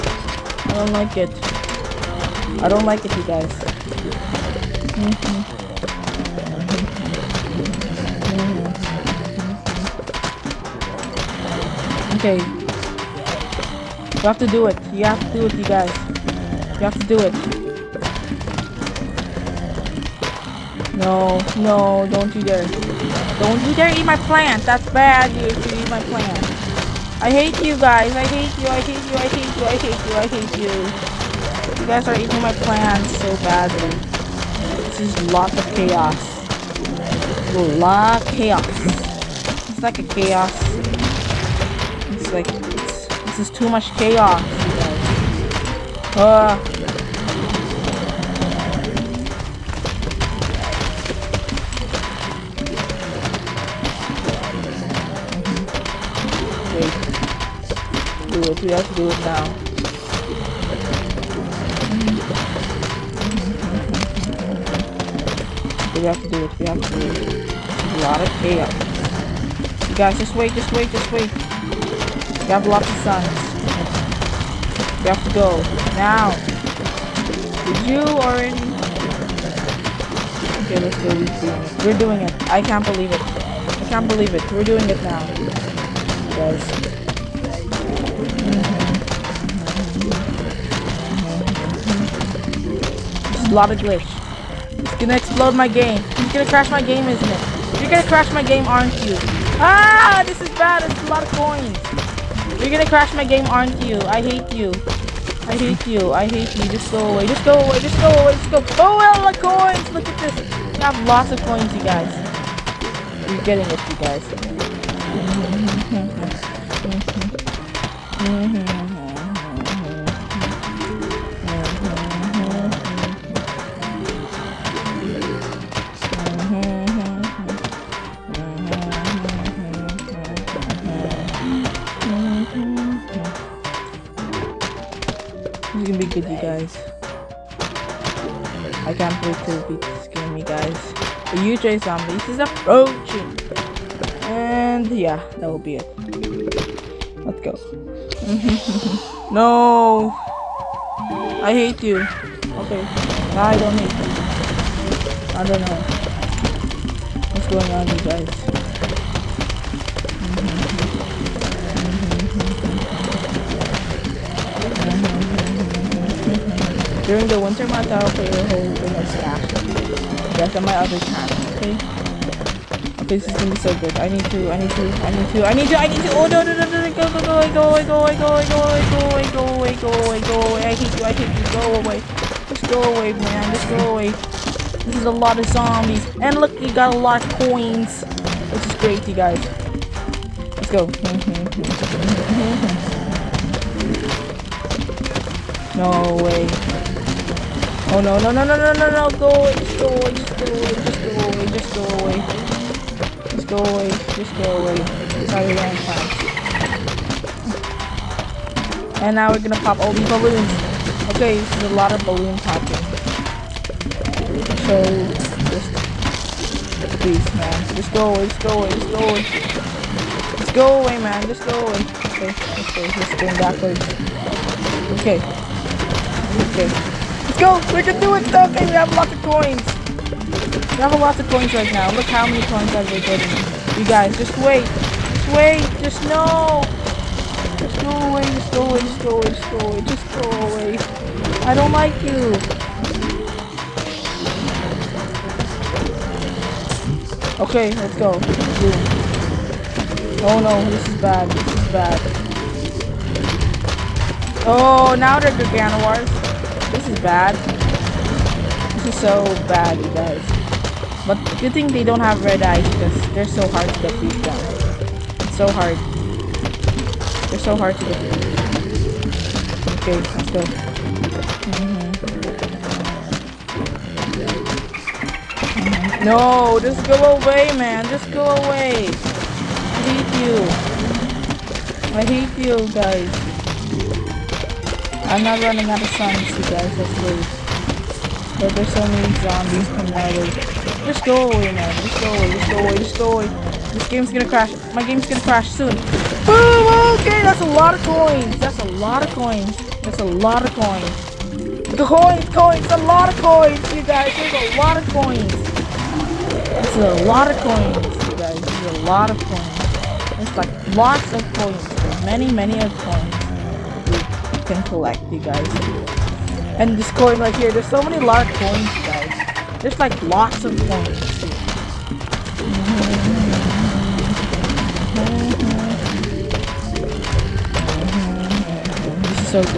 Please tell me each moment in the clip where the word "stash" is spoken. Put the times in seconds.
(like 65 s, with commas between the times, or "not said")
169 s.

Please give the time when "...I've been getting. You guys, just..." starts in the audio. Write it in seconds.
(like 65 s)
232 s.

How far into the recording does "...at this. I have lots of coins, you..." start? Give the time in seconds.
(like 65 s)
110 s.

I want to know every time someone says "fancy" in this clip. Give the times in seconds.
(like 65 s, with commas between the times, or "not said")
not said.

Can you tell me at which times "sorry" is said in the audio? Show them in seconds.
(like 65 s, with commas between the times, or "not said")
not said.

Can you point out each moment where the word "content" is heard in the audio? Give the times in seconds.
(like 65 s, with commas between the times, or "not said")
not said.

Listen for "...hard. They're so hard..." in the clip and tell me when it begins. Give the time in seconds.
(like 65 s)
265 s.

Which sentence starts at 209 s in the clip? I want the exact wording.
And now we're gonna pop all these balloons.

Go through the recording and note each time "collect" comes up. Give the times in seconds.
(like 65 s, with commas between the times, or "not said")
314 s.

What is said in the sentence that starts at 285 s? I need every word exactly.
I'm not running out of songs, you guys, that's weird.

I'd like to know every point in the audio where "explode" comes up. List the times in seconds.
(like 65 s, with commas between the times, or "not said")
95 s.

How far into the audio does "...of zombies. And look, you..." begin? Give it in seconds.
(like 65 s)
185 s.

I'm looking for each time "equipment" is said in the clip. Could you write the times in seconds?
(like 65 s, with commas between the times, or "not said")
not said.